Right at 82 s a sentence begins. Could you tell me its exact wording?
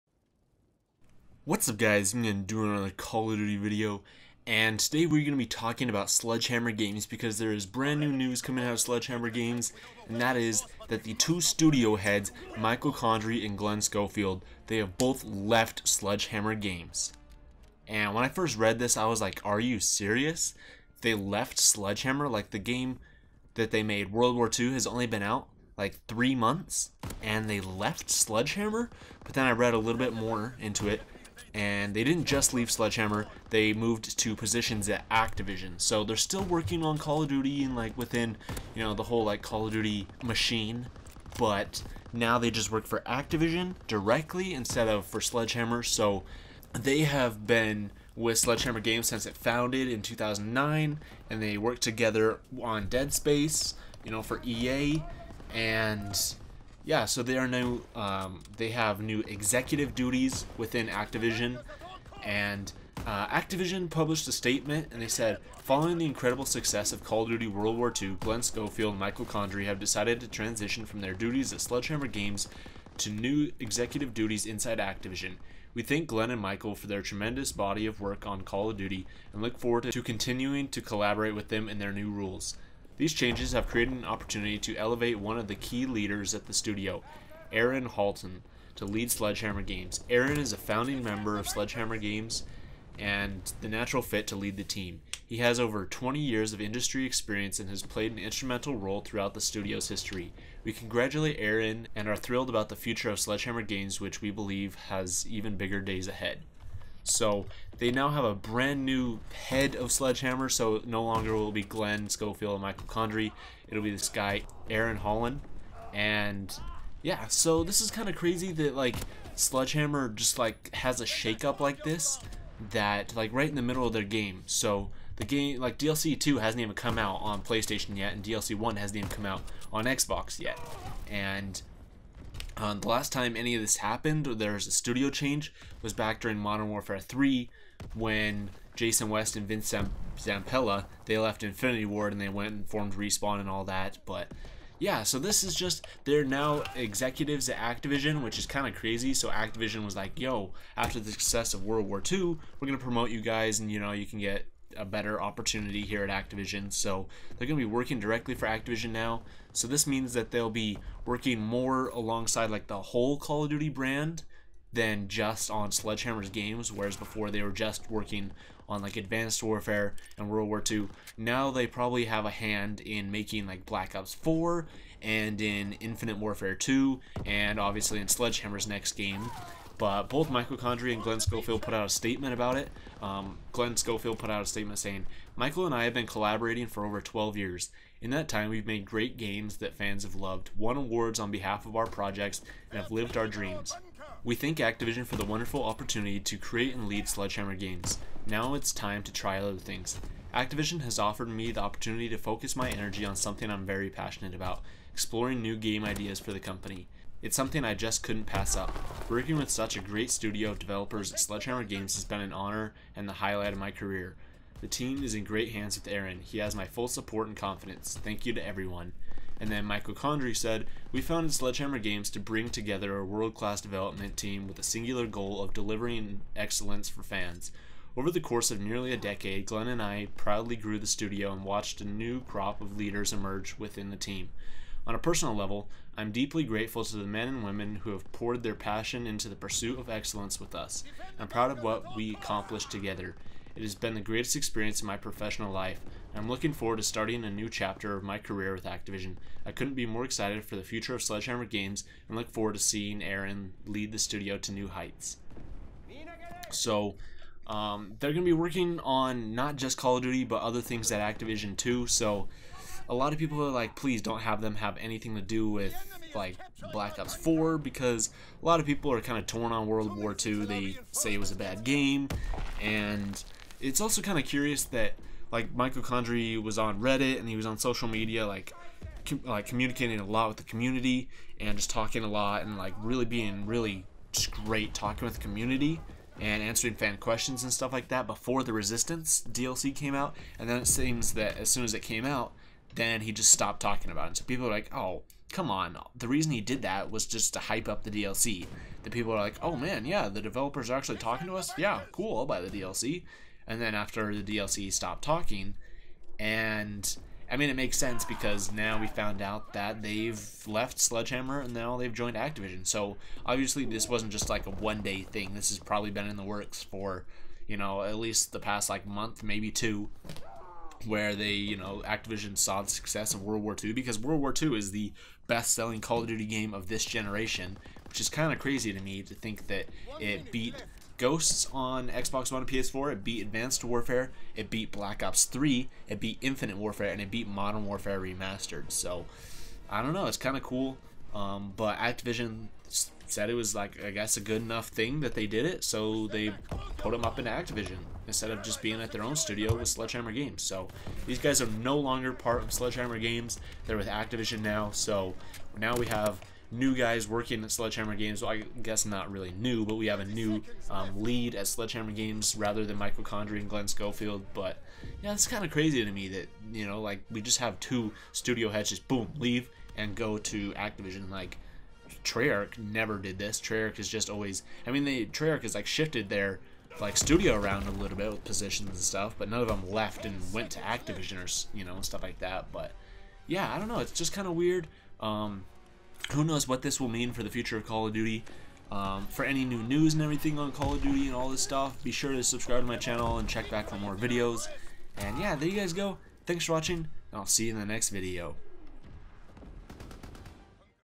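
These changes have created an opportunity to elevate one of the key leaders at the studio, Aaron Halon, to lead Sledgehammer Games.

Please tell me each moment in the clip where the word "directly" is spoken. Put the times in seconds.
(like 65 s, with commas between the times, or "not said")
43 s, 157 s.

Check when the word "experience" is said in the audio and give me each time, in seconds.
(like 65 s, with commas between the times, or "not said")
97 s, 244 s.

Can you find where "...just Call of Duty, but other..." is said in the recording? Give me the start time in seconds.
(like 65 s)
259 s.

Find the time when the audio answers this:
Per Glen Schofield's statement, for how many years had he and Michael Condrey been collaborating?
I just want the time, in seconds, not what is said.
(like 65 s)
186 s.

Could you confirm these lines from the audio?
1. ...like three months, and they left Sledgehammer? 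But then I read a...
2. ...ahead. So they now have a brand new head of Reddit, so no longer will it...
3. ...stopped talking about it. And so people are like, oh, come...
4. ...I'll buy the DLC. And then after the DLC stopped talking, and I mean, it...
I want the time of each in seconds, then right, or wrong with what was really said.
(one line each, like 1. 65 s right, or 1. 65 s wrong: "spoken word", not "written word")
1. 25 s right
2. 106 s wrong: "Sledgehammer", not "Reddit"
3. 293 s right
4. 302 s right.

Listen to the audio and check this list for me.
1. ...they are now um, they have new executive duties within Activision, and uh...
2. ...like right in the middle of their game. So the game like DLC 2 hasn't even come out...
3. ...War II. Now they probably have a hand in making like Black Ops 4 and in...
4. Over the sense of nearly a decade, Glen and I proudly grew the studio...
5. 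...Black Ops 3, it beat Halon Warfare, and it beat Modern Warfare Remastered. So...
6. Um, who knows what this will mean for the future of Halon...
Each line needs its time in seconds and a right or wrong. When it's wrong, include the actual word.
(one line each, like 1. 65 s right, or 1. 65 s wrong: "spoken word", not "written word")
1. 57 s right
2. 123 s right
3. 170 s right
4. 227 s wrong: "course", not "sense"
5. 334 s wrong: "Infinite", not "Halon"
6. 384 s wrong: "Call", not "Halon".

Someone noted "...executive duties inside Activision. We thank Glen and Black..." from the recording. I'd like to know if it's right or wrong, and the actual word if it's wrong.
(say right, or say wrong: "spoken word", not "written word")
wrong: "Michael", not "Black".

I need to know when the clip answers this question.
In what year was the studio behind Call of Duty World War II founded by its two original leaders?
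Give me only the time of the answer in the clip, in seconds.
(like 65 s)
50 s.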